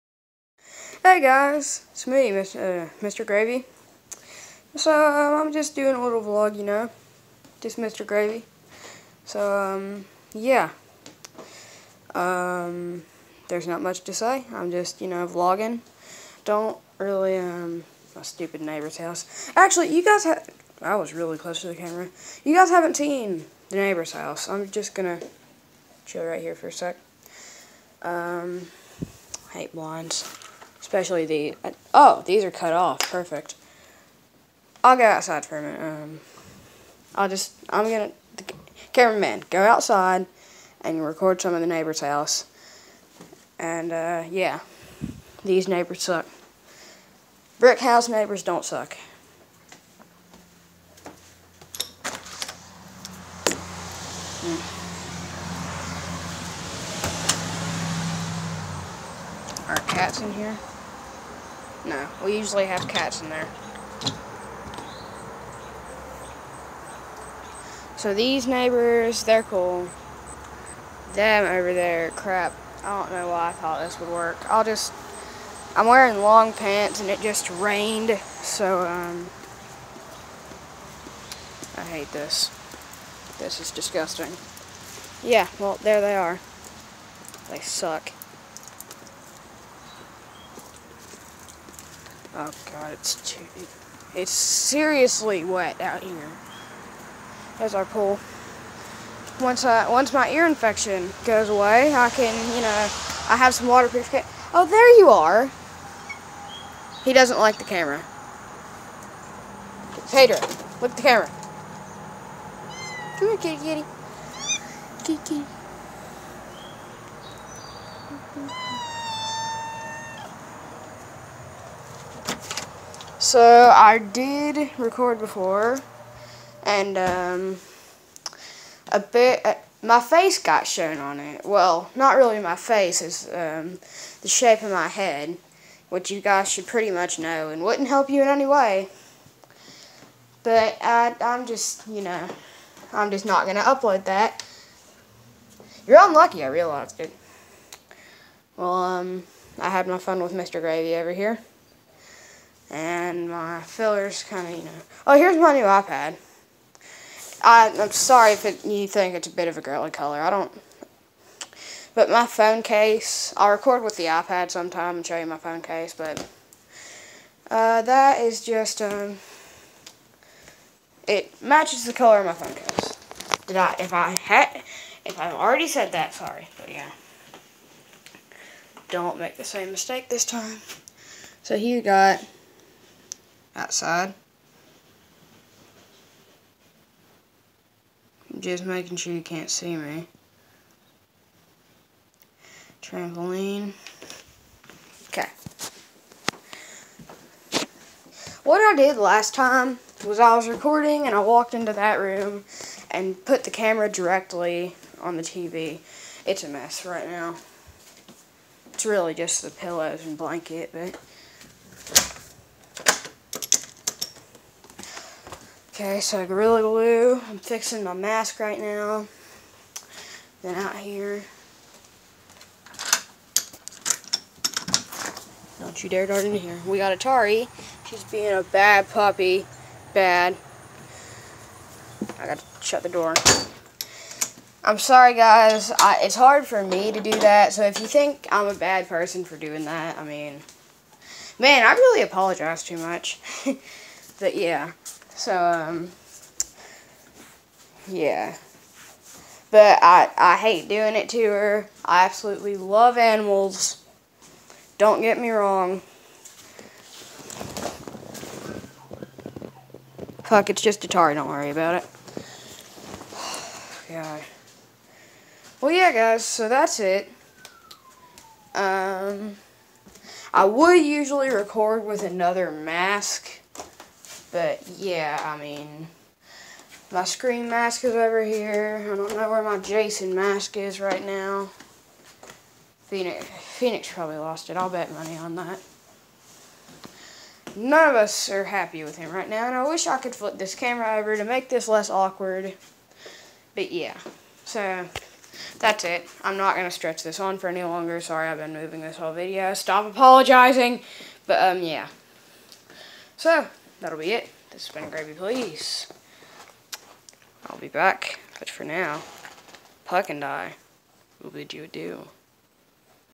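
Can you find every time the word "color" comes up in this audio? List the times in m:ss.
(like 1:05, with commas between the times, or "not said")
2:39, 2:51.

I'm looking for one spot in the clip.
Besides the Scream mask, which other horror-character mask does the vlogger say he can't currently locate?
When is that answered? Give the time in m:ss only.
4:39.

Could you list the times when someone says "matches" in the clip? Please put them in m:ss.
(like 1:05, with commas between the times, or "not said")
2:51.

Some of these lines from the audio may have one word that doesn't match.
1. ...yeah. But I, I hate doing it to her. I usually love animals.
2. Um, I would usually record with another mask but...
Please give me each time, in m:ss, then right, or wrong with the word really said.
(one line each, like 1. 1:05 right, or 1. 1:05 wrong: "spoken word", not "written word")
1. 4:07 wrong: "absolutely", not "usually"
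2. 4:28 right.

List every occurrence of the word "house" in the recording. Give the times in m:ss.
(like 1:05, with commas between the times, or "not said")
0:18, 0:24, 0:41, 0:47.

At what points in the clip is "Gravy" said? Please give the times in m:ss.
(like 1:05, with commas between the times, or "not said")
0:03, 0:08, 2:30, 5:04.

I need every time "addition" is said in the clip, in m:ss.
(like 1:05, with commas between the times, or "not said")
not said.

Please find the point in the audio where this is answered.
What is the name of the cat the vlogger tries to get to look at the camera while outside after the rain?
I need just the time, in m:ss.
1:50.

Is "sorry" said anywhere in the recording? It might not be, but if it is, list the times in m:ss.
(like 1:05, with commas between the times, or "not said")
2:37, 2:56, 3:54, 4:57.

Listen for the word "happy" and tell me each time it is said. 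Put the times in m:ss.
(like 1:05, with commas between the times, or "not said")
4:48.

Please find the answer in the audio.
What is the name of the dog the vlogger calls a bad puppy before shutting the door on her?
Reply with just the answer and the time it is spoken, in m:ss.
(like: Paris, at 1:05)
Atari, at 3:46.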